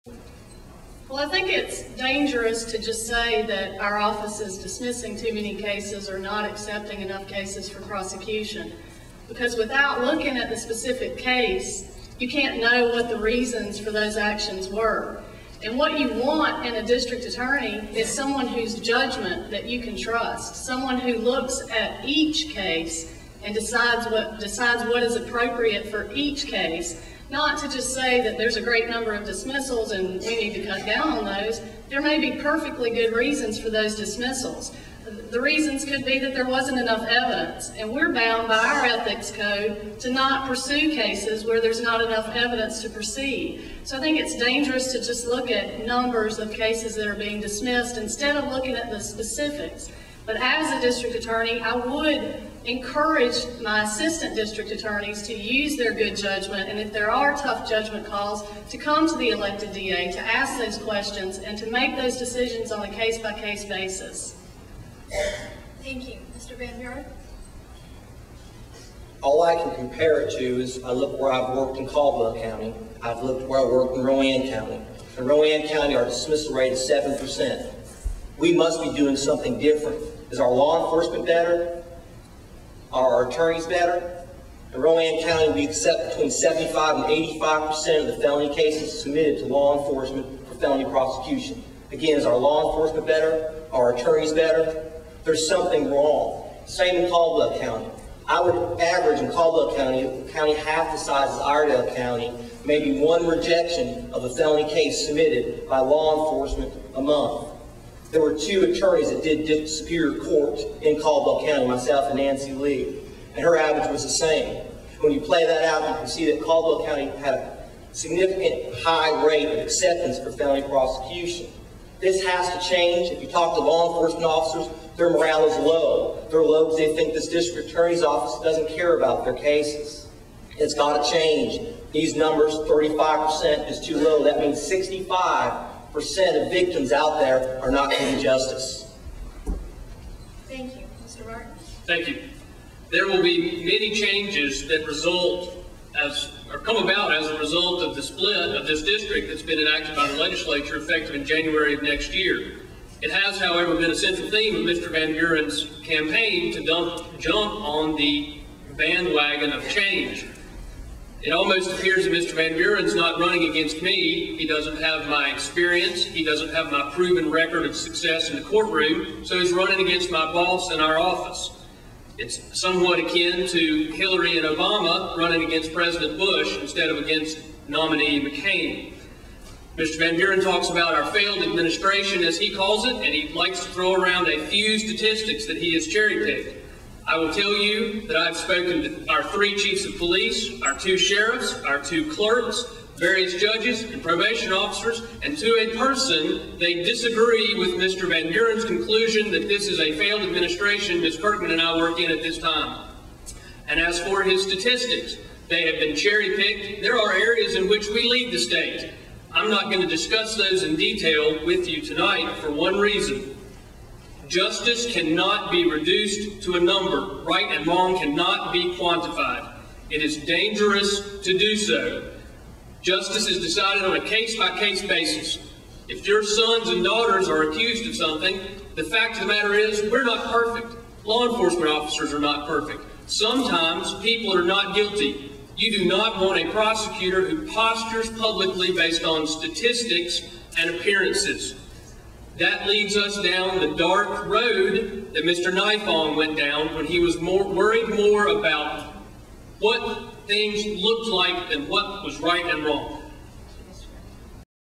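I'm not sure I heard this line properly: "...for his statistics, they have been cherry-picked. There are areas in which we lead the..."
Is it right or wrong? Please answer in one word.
right.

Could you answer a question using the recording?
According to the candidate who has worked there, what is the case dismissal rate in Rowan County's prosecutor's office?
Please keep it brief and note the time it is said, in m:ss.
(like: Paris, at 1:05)
7%, at 1:16.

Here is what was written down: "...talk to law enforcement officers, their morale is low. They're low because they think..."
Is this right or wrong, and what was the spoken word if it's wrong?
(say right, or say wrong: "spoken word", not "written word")
right.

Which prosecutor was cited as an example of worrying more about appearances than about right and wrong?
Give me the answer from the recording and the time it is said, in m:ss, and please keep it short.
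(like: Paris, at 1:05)
Nifong, at 4:05.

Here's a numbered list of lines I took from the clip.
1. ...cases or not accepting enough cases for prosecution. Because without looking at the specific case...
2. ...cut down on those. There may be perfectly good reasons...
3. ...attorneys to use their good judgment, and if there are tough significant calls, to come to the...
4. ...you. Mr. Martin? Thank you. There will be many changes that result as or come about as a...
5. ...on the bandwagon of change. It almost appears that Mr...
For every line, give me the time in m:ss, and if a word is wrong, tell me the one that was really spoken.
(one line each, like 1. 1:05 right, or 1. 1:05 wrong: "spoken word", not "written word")
1. 0:05 right
2. 0:30 right
3. 0:54 wrong: "judgment", not "significant"
4. 2:20 right
5. 2:37 right.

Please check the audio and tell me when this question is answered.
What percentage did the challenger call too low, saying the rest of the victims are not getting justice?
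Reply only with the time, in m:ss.
2:12.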